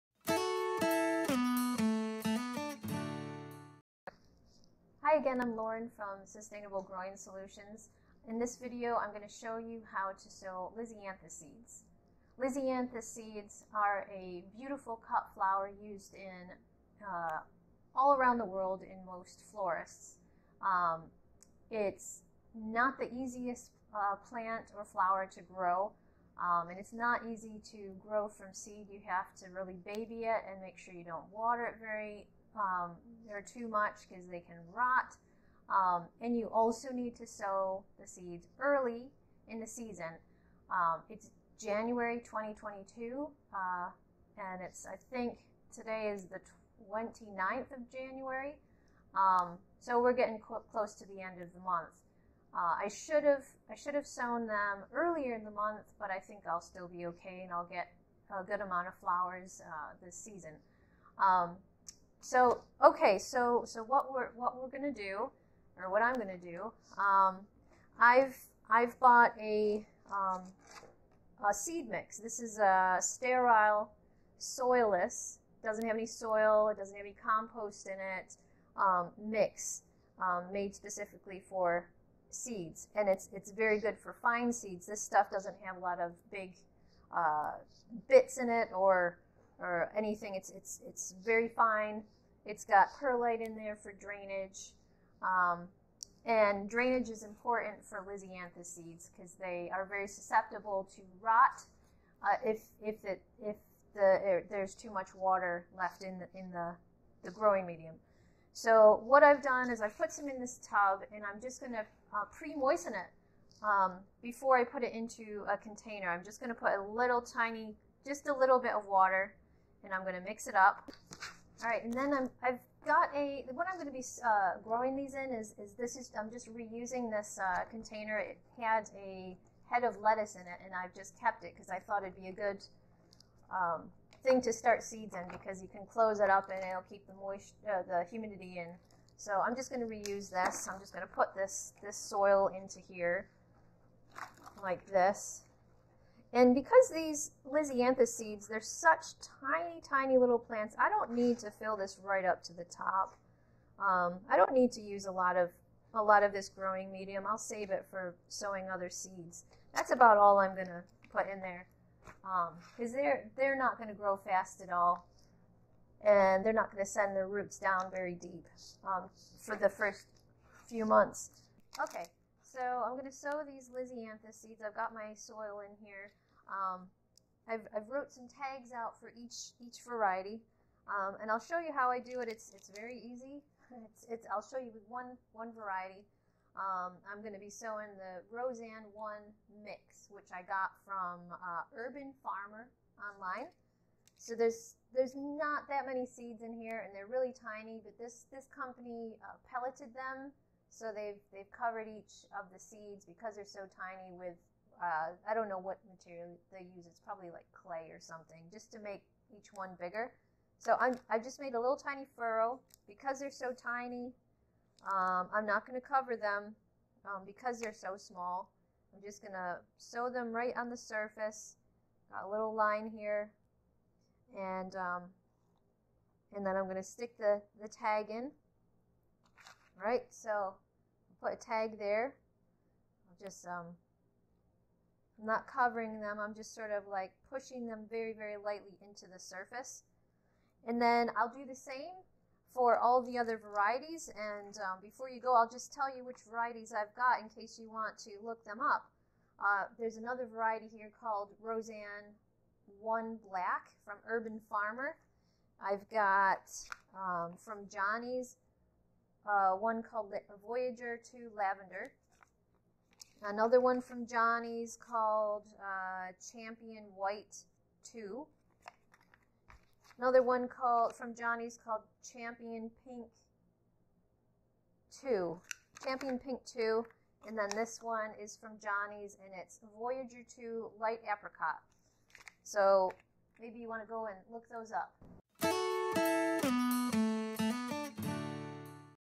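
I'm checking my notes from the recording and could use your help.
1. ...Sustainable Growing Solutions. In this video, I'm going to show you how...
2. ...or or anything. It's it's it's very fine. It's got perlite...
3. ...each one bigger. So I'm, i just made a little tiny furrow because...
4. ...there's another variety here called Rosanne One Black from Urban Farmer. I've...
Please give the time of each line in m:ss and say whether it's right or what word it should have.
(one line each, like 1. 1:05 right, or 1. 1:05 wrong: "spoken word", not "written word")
1. 0:06 right
2. 1:28 right
3. 3:29 right
4. 4:09 right.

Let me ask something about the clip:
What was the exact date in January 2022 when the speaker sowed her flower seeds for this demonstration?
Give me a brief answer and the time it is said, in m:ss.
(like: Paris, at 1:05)
29th of January, at 0:46.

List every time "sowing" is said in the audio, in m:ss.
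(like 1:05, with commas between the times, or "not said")
2:38, 3:07.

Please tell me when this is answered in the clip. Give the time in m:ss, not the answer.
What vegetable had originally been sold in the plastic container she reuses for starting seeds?
2:10.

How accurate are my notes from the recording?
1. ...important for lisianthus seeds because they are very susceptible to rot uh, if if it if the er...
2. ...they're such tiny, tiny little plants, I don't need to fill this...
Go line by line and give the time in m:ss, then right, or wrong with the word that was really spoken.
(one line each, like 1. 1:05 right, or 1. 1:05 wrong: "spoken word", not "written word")
1. 1:37 right
2. 2:28 right.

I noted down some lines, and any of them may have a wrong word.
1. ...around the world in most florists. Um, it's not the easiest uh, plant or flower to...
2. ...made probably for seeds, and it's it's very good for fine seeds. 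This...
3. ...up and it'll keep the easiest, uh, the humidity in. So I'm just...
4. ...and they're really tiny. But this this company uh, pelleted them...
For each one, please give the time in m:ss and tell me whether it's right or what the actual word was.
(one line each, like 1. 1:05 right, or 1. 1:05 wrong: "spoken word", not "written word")
1. 0:18 right
2. 1:20 wrong: "specifically", not "probably"
3. 2:16 wrong: "moist", not "easiest"
4. 3:16 right.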